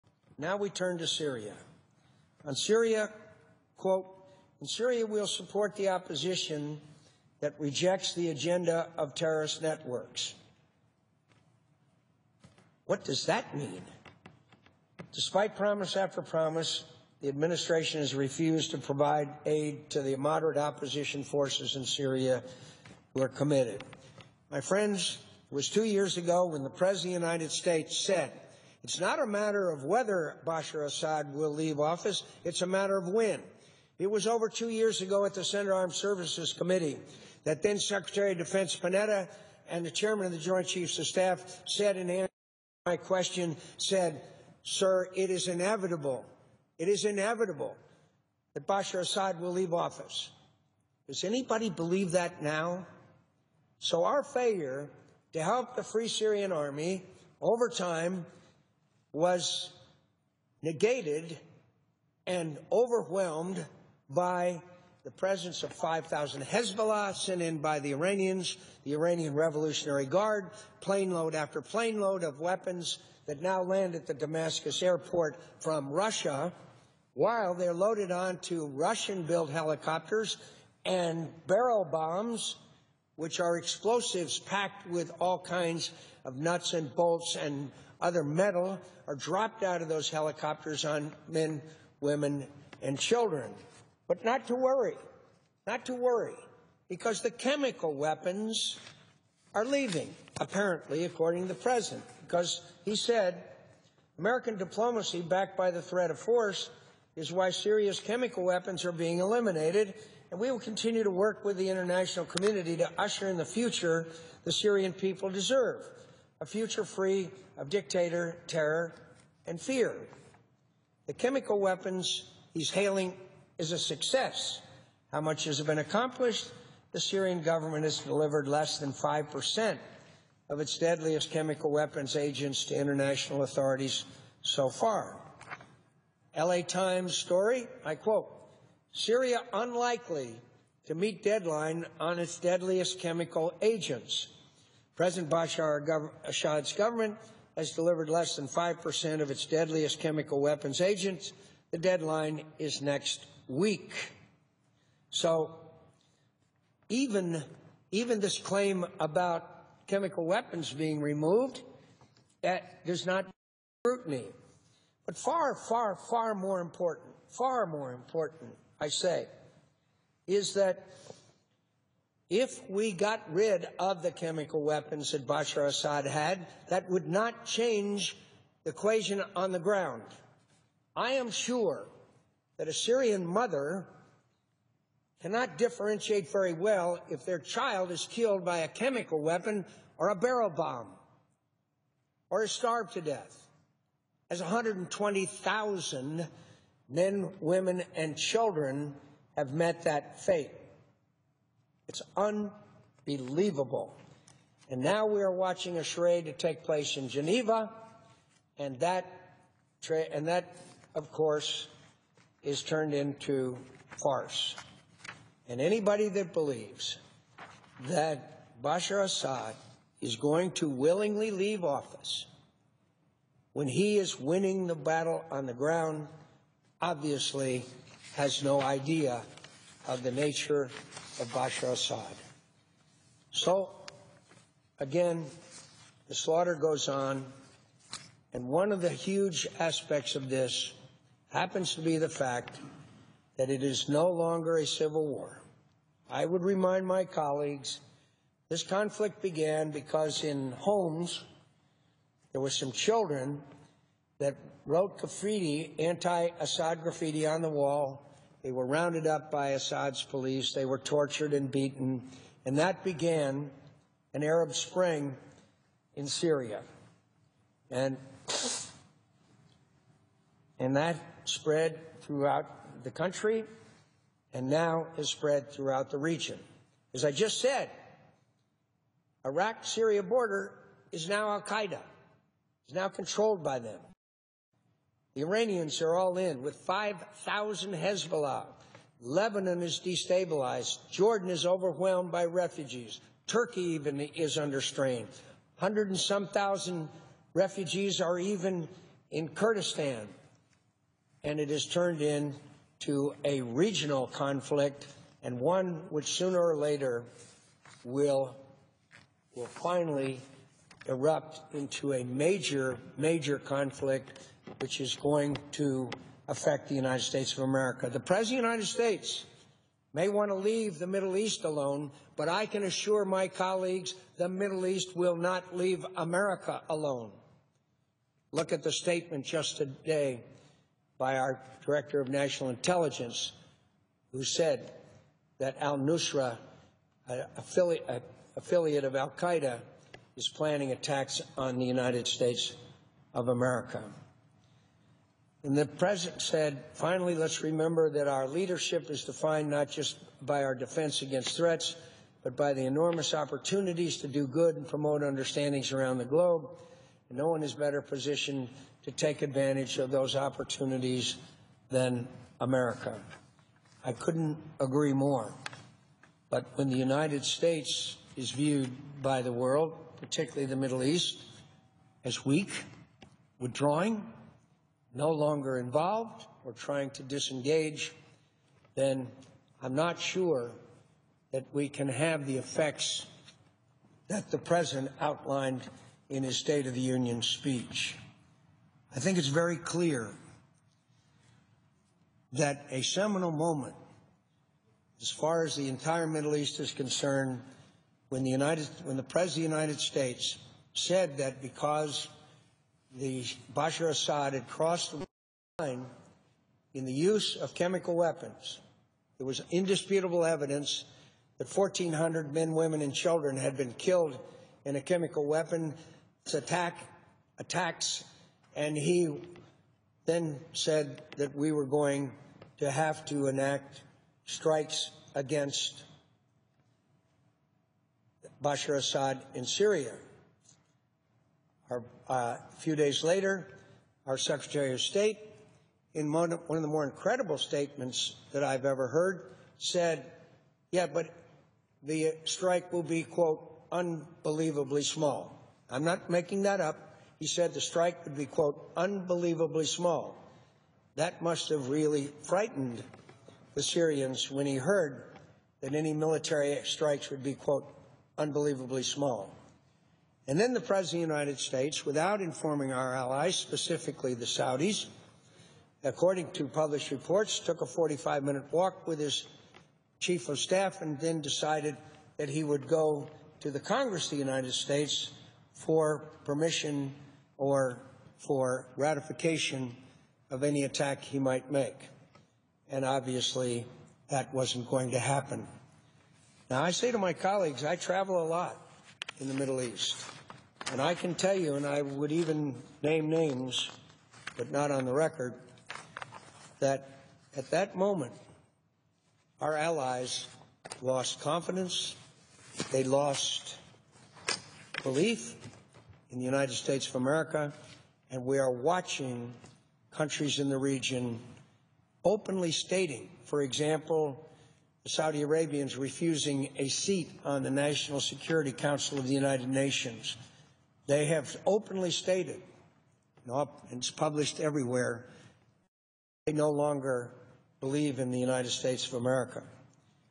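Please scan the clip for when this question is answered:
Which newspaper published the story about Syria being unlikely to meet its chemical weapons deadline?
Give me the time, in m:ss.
2:16.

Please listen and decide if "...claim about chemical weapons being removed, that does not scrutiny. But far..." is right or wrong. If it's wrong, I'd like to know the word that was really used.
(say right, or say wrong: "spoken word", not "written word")
right.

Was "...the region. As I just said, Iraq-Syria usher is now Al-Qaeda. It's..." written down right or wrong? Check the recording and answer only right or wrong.
wrong.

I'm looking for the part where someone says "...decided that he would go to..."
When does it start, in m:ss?
7:51.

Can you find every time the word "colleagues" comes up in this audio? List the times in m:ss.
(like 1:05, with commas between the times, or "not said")
4:07, 5:23, 8:07.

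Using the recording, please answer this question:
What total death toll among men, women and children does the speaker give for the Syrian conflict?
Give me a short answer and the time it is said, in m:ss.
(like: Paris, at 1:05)
120,000, at 3:14.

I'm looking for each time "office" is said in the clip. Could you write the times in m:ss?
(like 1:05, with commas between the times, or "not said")
0:31, 0:49, 3:41.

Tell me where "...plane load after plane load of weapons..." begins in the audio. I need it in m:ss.
1:10.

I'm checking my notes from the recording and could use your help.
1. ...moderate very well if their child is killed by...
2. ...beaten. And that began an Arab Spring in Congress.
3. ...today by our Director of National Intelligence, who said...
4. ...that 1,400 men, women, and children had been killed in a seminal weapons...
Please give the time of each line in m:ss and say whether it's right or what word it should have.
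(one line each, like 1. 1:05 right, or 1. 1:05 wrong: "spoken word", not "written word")
1. 3:05 wrong: "differentiate", not "moderate"
2. 4:21 wrong: "Syria", not "Congress"
3. 5:29 right
4. 6:51 wrong: "chemical", not "seminal".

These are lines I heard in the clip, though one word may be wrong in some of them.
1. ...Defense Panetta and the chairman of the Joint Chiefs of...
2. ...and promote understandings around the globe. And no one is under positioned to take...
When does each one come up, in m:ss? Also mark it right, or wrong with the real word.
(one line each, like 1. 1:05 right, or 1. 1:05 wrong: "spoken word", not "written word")
1. 0:38 right
2. 5:54 wrong: "better", not "under".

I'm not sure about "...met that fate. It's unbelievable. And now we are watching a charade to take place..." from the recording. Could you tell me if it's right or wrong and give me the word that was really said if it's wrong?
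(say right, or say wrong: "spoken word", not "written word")
right.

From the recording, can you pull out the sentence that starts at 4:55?
Hundred and some thousand refugees are even in Kurdistan.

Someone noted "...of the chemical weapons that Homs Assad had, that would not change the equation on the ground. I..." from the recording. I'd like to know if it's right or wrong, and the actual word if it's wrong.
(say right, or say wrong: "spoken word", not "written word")
wrong: "Bashar", not "Homs".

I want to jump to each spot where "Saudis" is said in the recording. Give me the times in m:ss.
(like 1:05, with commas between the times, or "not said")
7:44, 8:34.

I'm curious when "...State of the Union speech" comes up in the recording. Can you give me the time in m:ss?
6:26.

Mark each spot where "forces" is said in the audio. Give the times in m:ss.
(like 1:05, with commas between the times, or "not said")
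0:21, 1:46.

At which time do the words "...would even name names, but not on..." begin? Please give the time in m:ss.
8:11.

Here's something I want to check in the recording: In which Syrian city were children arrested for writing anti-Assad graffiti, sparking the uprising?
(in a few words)
Homs.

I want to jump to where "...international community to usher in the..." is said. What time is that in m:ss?
1:51.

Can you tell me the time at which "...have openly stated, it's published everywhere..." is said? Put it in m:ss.
8:41.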